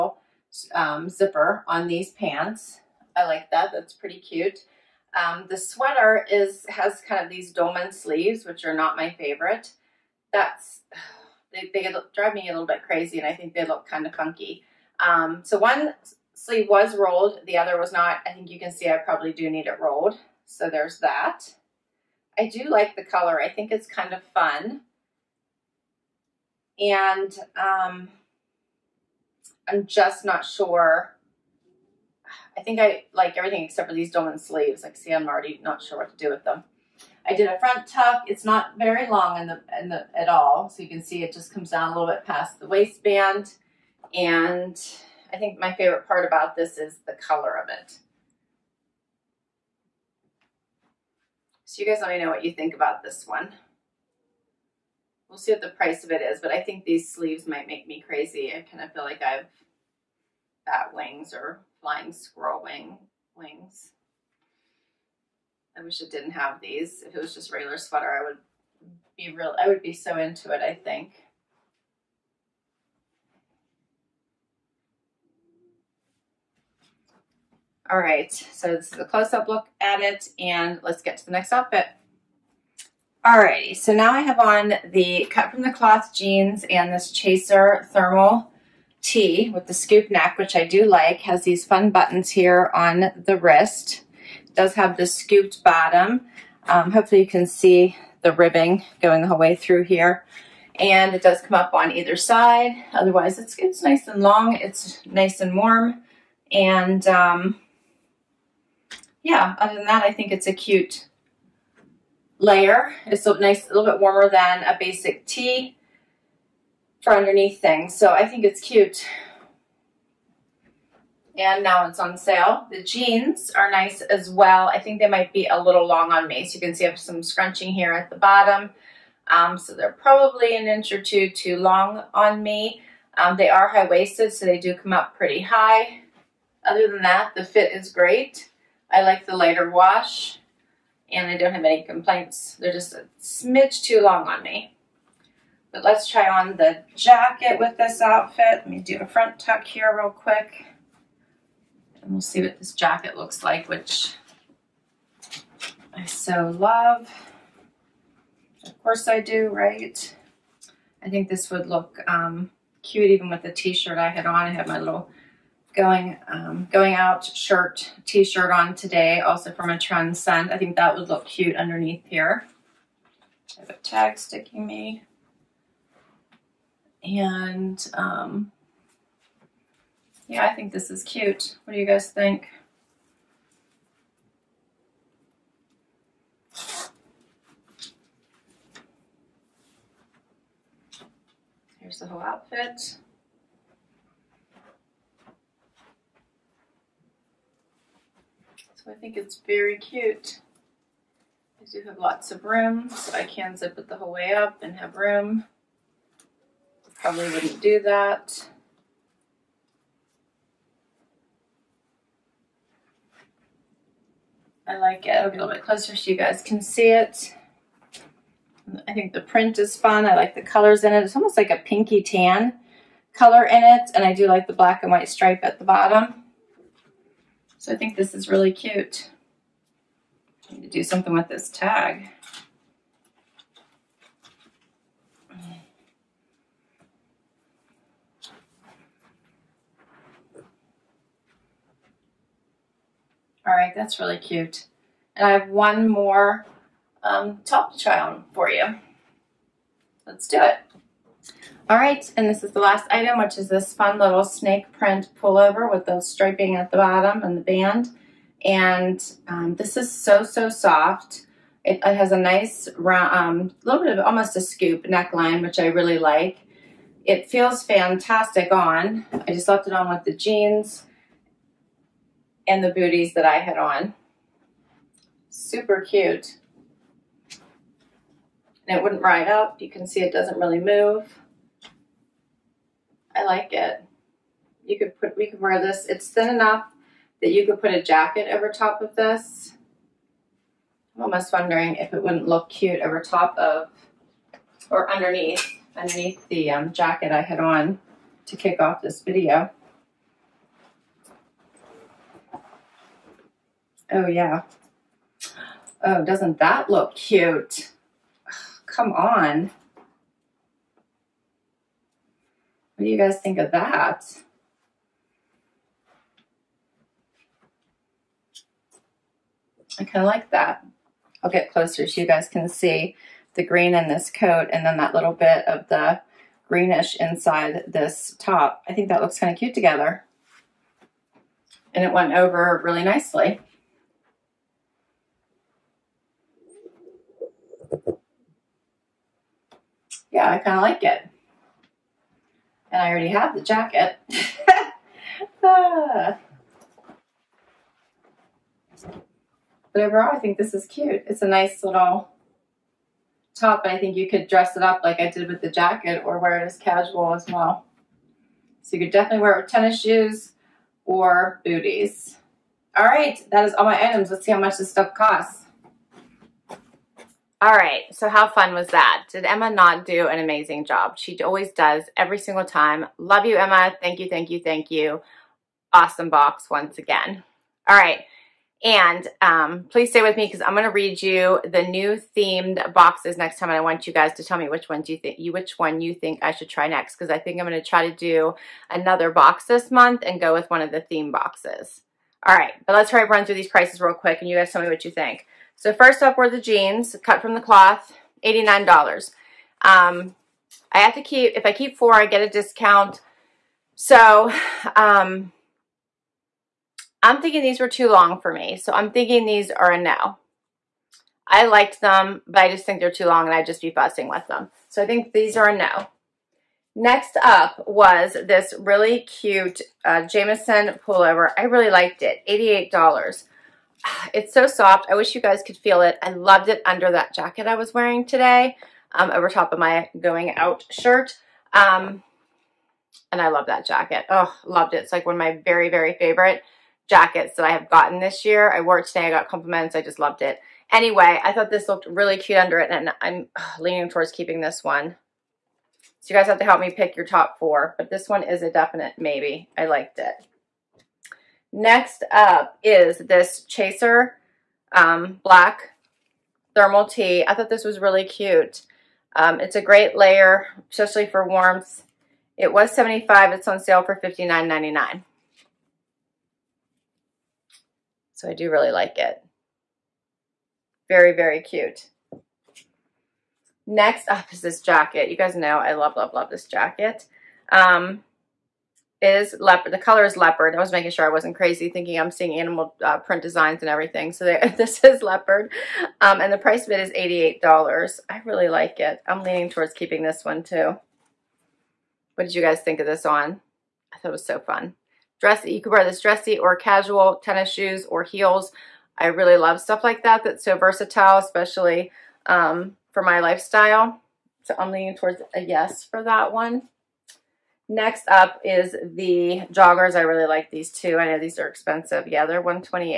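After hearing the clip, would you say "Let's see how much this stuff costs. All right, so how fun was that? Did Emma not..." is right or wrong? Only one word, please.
right.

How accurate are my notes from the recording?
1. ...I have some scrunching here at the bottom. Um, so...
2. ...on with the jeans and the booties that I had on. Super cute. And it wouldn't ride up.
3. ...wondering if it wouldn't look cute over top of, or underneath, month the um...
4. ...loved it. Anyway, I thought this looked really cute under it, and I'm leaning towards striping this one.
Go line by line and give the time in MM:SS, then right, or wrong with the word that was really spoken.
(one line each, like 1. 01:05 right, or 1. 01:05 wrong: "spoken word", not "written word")
1. 02:06 right
2. 04:29 right
3. 04:51 wrong: "underneath", not "month"
4. 07:19 wrong: "keeping", not "striping".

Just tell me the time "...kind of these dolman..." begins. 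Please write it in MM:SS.
00:07.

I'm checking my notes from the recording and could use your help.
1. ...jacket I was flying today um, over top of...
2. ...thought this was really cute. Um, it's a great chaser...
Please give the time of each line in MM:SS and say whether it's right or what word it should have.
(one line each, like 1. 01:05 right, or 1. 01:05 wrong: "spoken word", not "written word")
1. 07:07 wrong: "wearing", not "flying"
2. 07:37 wrong: "layer", not "chaser".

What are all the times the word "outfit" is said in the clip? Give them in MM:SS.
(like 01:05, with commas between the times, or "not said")
01:21, 02:28, 03:12.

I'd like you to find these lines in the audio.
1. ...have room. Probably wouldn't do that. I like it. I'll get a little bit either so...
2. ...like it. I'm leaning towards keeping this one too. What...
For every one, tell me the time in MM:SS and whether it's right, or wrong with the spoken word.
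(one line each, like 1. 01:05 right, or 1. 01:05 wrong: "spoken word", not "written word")
1. 03:24 wrong: "closer", not "either"
2. 08:08 right.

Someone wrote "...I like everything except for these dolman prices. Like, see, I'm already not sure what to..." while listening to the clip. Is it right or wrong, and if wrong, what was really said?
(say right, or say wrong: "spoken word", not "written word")
wrong: "sleeves", not "prices".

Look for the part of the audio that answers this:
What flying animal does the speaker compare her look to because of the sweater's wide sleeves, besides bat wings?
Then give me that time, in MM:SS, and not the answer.
01:01.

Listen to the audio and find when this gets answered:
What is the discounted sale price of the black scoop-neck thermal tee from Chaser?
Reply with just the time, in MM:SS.
07:44.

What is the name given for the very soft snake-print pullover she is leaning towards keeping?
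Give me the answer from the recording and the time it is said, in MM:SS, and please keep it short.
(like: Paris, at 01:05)
Jamison, at 07:00.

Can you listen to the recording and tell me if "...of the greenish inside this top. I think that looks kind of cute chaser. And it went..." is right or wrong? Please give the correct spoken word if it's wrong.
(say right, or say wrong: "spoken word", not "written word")
wrong: "together", not "chaser".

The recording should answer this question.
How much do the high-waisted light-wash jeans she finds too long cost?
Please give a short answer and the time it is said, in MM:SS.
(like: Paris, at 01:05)
$89, at 06:38.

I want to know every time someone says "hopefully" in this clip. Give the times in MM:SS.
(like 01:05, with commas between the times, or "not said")
01:36.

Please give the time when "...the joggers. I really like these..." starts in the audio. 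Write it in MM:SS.
08:28.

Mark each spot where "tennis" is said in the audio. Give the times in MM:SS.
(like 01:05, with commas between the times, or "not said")
05:59, 08:17.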